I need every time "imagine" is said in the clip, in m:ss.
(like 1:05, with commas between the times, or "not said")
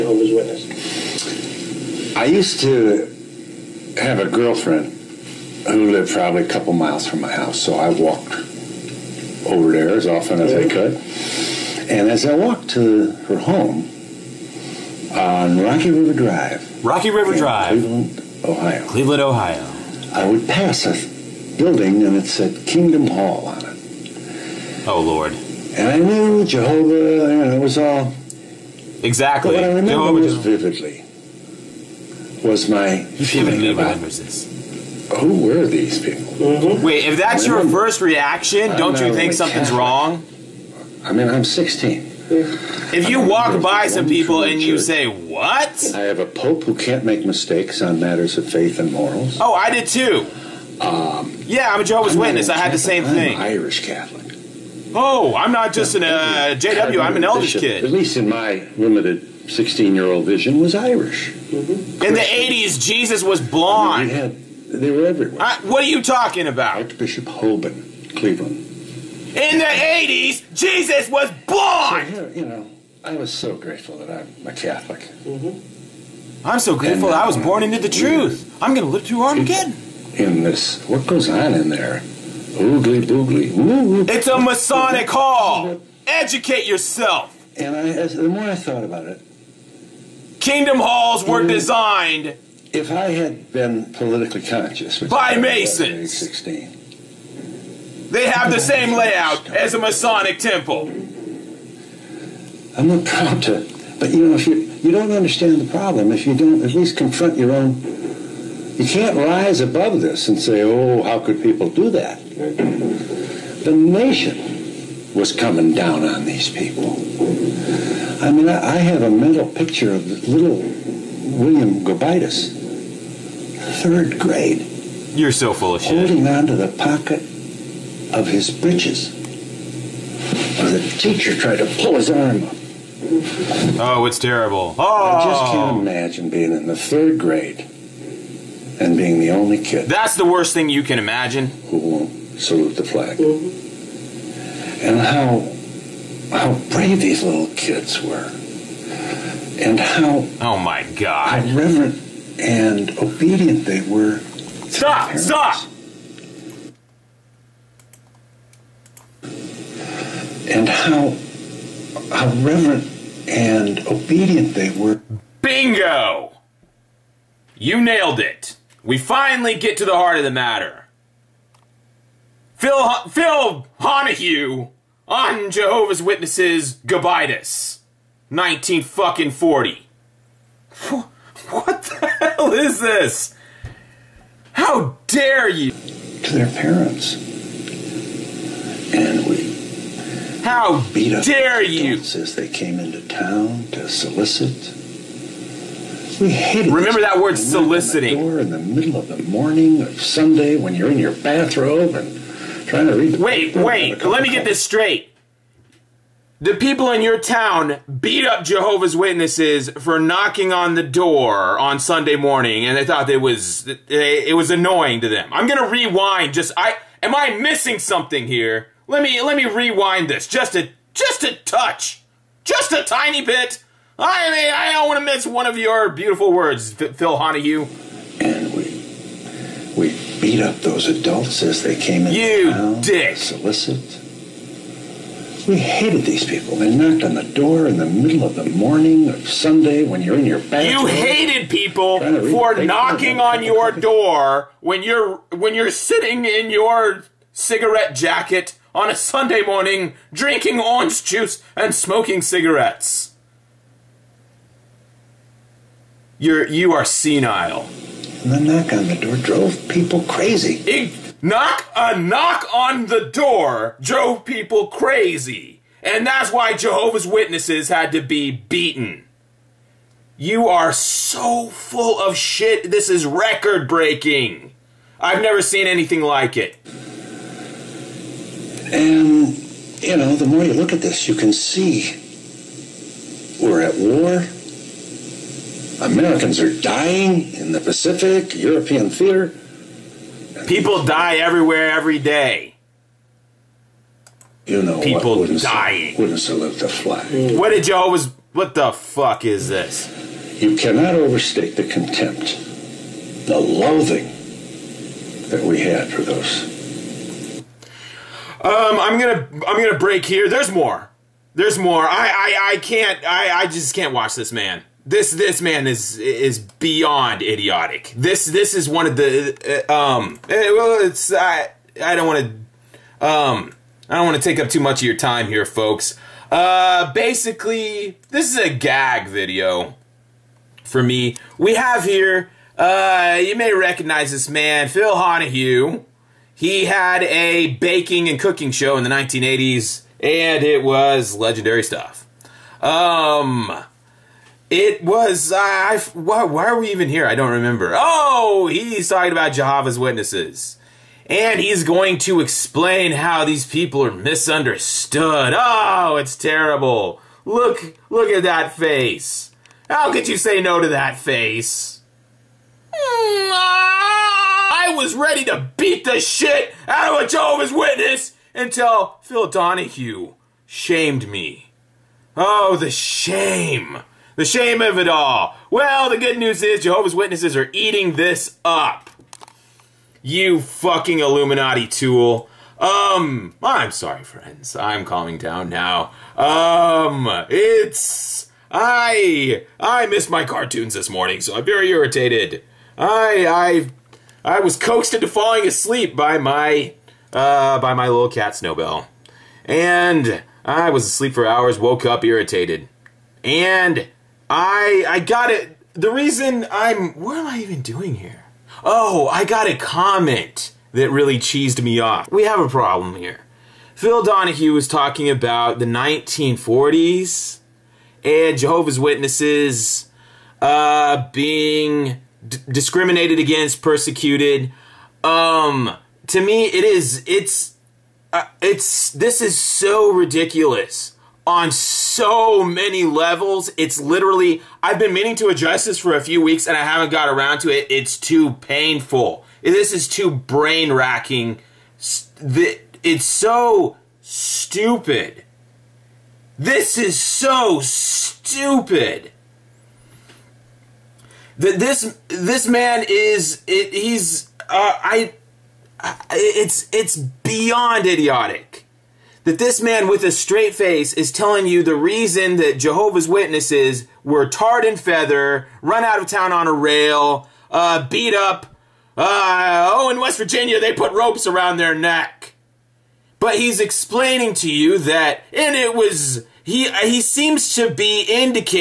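2:15, 2:20.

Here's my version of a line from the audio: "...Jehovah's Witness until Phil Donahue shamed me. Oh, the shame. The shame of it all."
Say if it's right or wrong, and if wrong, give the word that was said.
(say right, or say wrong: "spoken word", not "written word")
right.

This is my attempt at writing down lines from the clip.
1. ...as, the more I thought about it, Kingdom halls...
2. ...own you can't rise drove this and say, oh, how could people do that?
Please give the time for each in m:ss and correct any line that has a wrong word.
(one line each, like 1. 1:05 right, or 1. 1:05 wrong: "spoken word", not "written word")
1. 1:27 right
2. 1:47 wrong: "above", not "drove".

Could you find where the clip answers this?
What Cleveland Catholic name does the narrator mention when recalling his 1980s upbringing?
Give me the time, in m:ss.
1:06.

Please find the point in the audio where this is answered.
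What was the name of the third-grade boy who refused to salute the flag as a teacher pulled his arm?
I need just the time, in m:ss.
2:01.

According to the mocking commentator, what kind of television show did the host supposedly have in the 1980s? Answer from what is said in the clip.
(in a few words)
baking and cooking show.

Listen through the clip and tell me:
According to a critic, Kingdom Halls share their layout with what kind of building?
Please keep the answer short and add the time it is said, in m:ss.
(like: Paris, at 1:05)
Masonic temple, at 1:39.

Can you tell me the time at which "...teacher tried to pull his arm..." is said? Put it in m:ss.
2:10.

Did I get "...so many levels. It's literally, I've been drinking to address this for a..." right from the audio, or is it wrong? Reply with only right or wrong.
wrong.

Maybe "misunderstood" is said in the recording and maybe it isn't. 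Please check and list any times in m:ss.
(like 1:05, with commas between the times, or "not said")
5:53.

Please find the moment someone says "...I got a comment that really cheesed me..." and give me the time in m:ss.
6:49.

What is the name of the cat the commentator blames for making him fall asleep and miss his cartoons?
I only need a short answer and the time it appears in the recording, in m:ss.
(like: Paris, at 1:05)
Snowbell, at 6:38.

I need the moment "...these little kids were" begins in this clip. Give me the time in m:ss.
2:27.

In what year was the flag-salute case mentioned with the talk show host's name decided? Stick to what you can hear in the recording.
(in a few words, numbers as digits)
1940.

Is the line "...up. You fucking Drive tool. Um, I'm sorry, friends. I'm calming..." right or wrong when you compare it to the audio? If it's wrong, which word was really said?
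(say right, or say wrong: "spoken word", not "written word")
wrong: "Illuminati", not "Drive".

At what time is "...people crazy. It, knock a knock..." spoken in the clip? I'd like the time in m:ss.
4:19.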